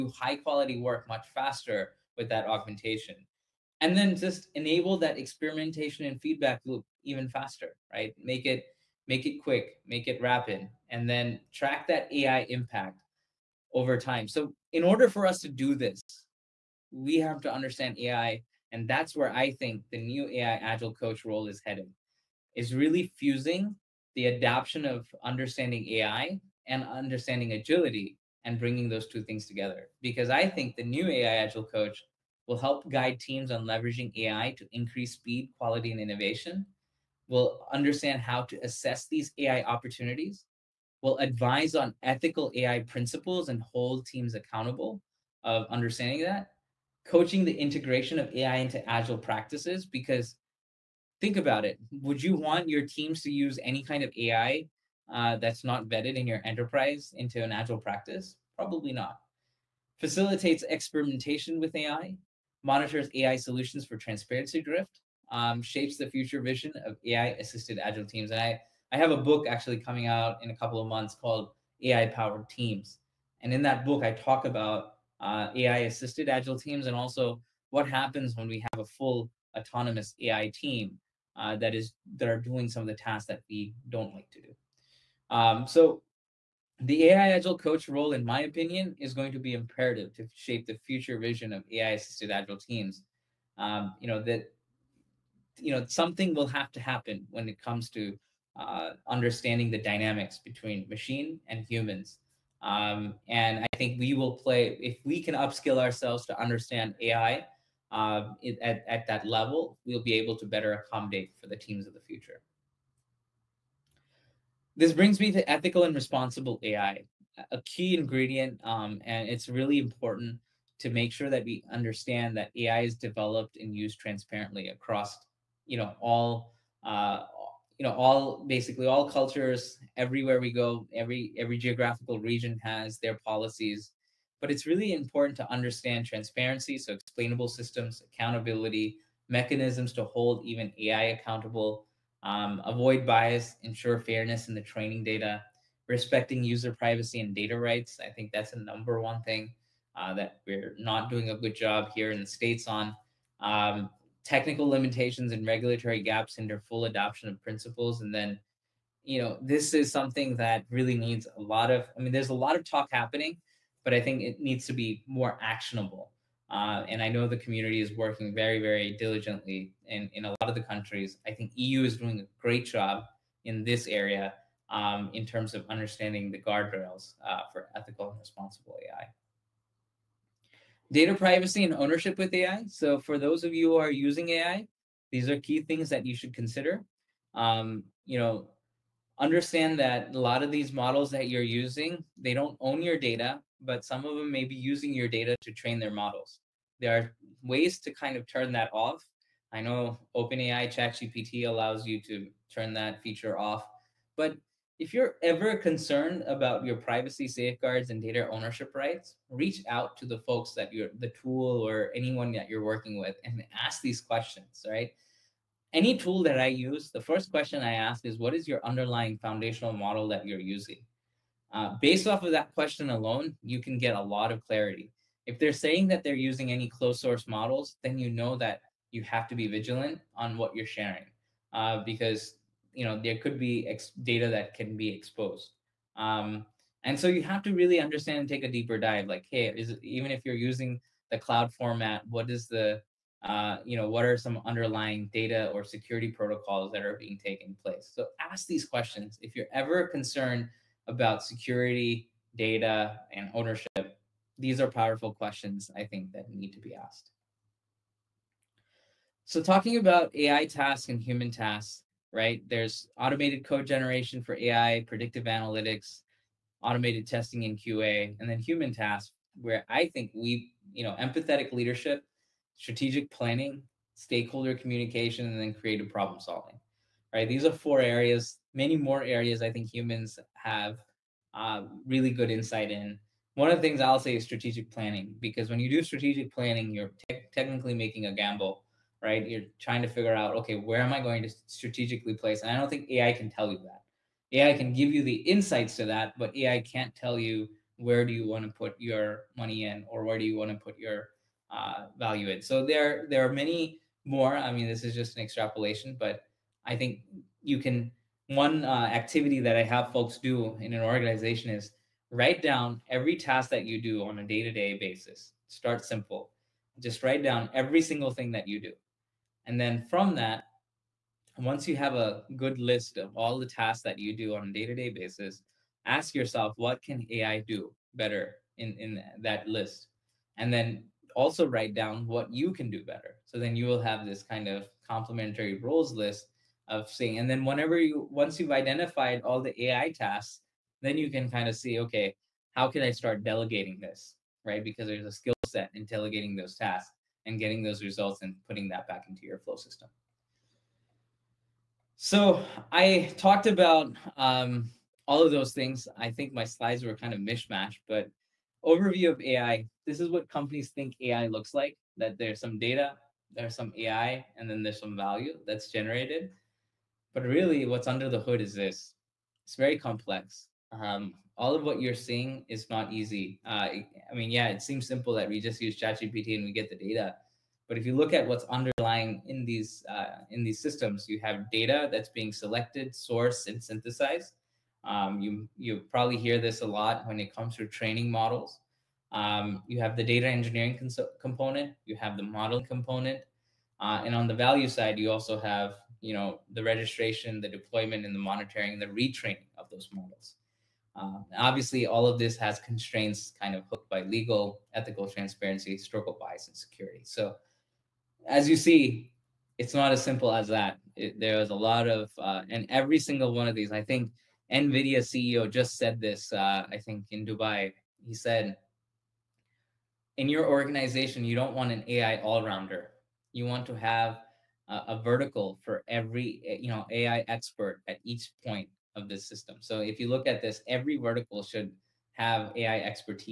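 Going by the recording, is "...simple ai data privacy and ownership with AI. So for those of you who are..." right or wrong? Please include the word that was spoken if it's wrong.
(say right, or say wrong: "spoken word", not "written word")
wrong: "responsible", not "simple".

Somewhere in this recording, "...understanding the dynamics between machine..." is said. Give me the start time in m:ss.
1:39.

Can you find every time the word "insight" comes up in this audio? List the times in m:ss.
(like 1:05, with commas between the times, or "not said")
4:42, 4:55.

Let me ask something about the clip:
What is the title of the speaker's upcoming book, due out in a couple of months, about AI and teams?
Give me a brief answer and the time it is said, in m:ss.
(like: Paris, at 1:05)
AI Powered Teams, at 1:11.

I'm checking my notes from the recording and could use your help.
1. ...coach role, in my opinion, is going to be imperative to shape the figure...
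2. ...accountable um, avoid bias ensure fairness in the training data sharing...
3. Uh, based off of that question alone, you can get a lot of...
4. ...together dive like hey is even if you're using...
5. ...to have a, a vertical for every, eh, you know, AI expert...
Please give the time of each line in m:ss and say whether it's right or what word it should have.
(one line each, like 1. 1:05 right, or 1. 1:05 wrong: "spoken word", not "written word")
1. 1:27 wrong: "future", not "figure"
2. 2:21 wrong: "respecting", not "sharing"
3. 3:41 right
4. 3:58 wrong: "deeper", not "together"
5. 7:03 right.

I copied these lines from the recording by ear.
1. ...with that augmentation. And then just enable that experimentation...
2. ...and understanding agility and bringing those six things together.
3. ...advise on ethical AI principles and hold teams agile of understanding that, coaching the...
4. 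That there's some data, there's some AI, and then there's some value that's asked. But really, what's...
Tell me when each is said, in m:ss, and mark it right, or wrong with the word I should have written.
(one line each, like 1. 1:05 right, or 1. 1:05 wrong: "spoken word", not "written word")
1. 0:02 right
2. 0:26 wrong: "two", not "six"
3. 0:41 wrong: "accountable", not "agile"
4. 6:01 wrong: "generated", not "asked".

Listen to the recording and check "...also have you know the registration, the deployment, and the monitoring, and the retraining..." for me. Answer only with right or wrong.
right.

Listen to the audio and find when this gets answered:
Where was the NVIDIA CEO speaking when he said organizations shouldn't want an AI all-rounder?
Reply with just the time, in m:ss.
6:57.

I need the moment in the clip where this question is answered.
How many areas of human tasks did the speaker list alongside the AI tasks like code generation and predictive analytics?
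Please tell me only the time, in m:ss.
4:37.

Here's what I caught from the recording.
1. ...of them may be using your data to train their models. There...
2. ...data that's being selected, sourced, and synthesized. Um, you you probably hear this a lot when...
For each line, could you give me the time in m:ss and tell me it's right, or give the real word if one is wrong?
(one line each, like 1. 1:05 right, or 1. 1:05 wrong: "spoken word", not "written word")
1. 3:14 right
2. 6:21 right.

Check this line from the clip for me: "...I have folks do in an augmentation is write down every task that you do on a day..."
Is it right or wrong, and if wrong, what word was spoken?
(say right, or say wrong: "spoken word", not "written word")
wrong: "organization", not "augmentation".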